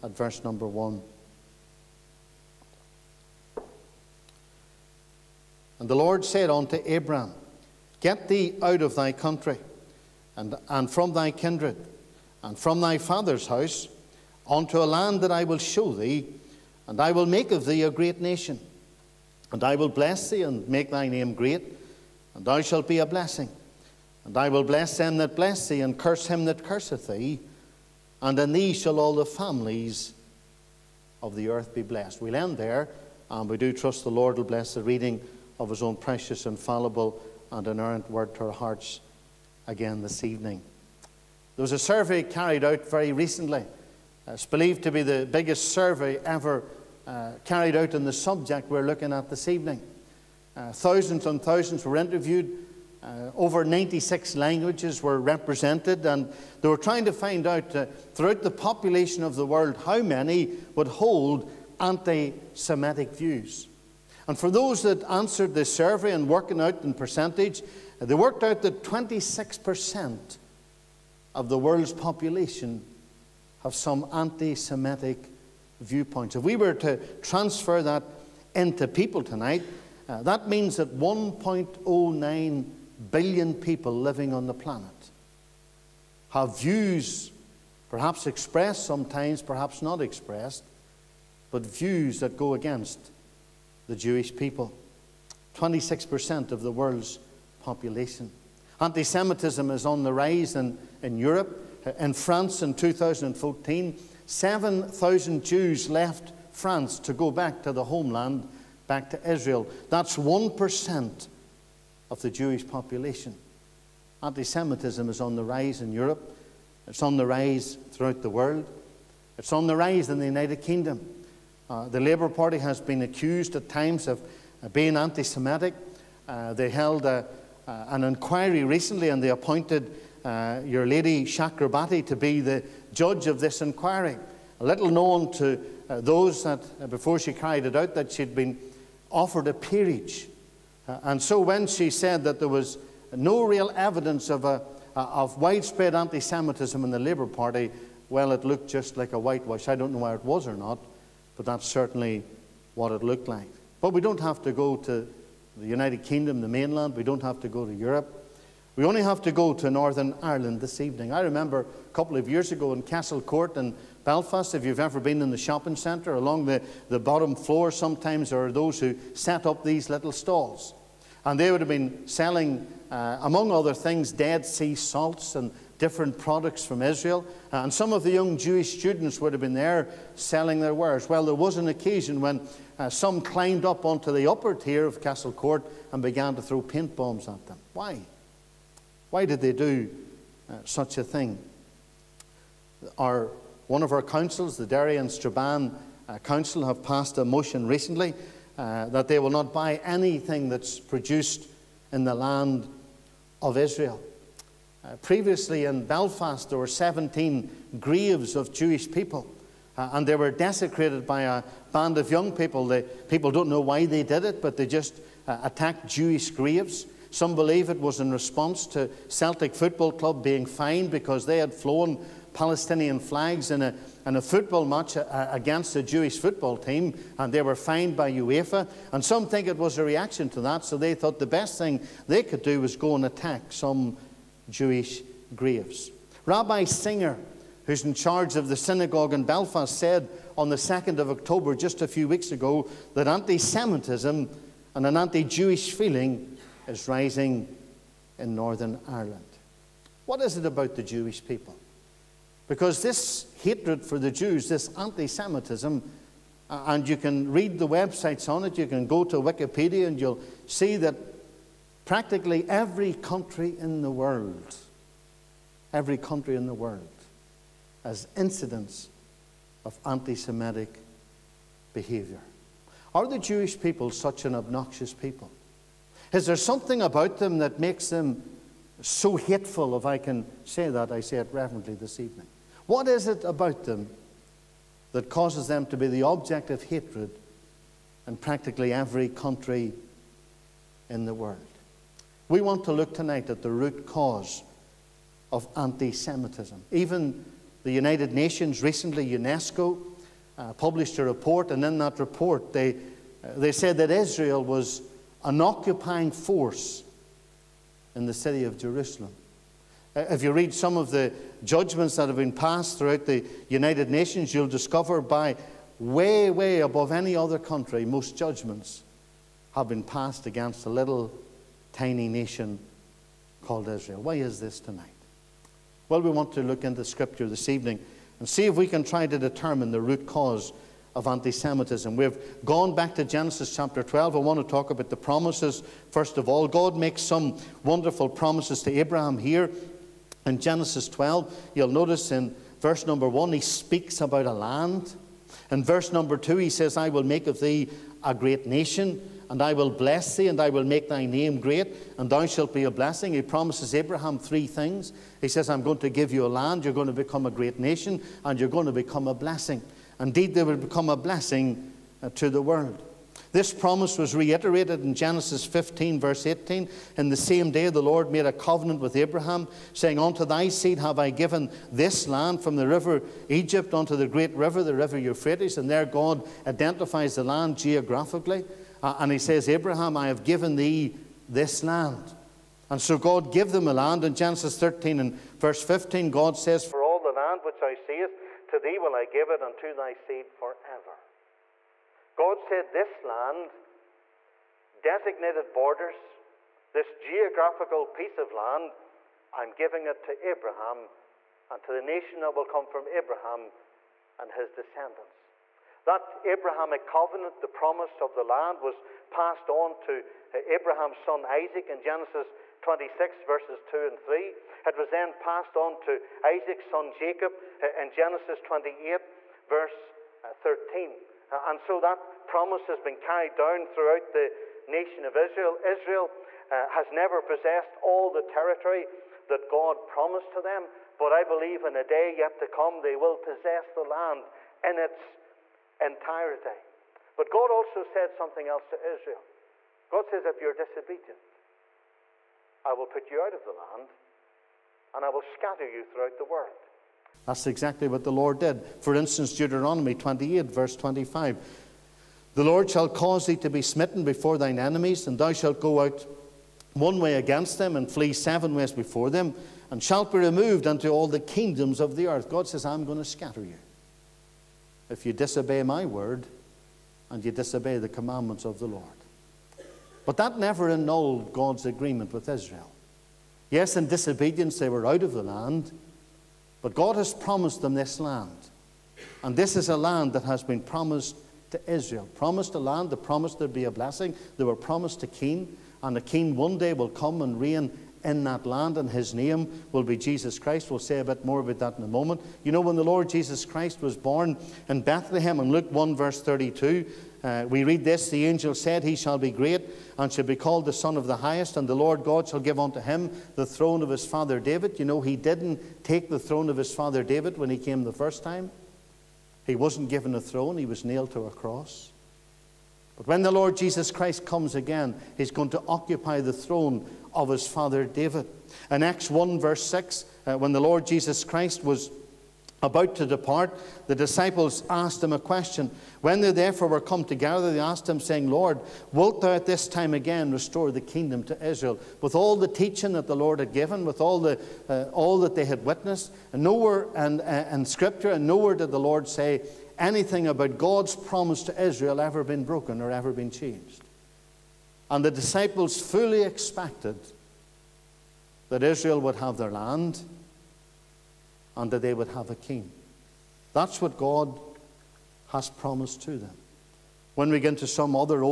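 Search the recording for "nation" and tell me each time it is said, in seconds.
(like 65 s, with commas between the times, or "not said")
18 s, 298 s, 313 s, 322 s, 348 s, 357 s, 401 s, 424 s.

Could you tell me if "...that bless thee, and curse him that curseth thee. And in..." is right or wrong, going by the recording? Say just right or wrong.
right.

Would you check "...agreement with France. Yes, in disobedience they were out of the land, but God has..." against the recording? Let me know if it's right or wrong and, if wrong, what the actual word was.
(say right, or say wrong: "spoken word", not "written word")
wrong: "Israel", not "France".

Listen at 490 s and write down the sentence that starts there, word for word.
We'll say a bit more about that in a moment.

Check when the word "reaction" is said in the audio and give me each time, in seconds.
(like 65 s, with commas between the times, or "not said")
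229 s.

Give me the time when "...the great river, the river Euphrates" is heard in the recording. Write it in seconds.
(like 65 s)
373 s.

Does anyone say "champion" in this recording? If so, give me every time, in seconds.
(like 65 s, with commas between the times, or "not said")
not said.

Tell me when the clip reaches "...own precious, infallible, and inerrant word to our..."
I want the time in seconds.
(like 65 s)
35 s.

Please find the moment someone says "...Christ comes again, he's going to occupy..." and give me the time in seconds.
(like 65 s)
513 s.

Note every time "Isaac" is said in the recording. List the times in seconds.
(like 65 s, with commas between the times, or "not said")
411 s, 416 s.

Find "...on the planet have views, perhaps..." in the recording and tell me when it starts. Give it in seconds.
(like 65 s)
84 s.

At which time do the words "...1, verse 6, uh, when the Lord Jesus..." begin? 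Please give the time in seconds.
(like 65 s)
519 s.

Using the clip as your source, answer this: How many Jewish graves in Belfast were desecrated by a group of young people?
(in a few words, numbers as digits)
17.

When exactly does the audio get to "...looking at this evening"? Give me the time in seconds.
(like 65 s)
48 s.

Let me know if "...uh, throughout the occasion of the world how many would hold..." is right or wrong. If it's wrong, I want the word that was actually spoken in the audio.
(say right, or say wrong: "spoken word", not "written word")
wrong: "population", not "occasion".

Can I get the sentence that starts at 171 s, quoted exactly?
And they would have been selling, uh, among other things, Dead Sea salts and different products from Israel.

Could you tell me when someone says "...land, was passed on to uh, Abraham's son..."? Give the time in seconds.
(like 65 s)
408 s.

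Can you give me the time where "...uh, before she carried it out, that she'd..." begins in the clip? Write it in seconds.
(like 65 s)
136 s.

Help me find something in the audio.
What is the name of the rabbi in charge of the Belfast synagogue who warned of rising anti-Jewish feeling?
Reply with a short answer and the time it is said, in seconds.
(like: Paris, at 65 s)
Rabbi Singer, at 236 s.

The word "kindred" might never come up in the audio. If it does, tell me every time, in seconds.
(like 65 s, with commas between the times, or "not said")
11 s.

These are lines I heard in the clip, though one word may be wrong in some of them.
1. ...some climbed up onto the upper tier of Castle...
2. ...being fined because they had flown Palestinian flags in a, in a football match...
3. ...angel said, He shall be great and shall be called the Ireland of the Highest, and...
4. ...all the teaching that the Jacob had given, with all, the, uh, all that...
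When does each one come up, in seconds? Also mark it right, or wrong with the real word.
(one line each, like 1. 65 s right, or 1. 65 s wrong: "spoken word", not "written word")
1. 182 s right
2. 220 s right
3. 498 s wrong: "Son", not "Ireland"
4. 532 s wrong: "Lord", not "Jacob".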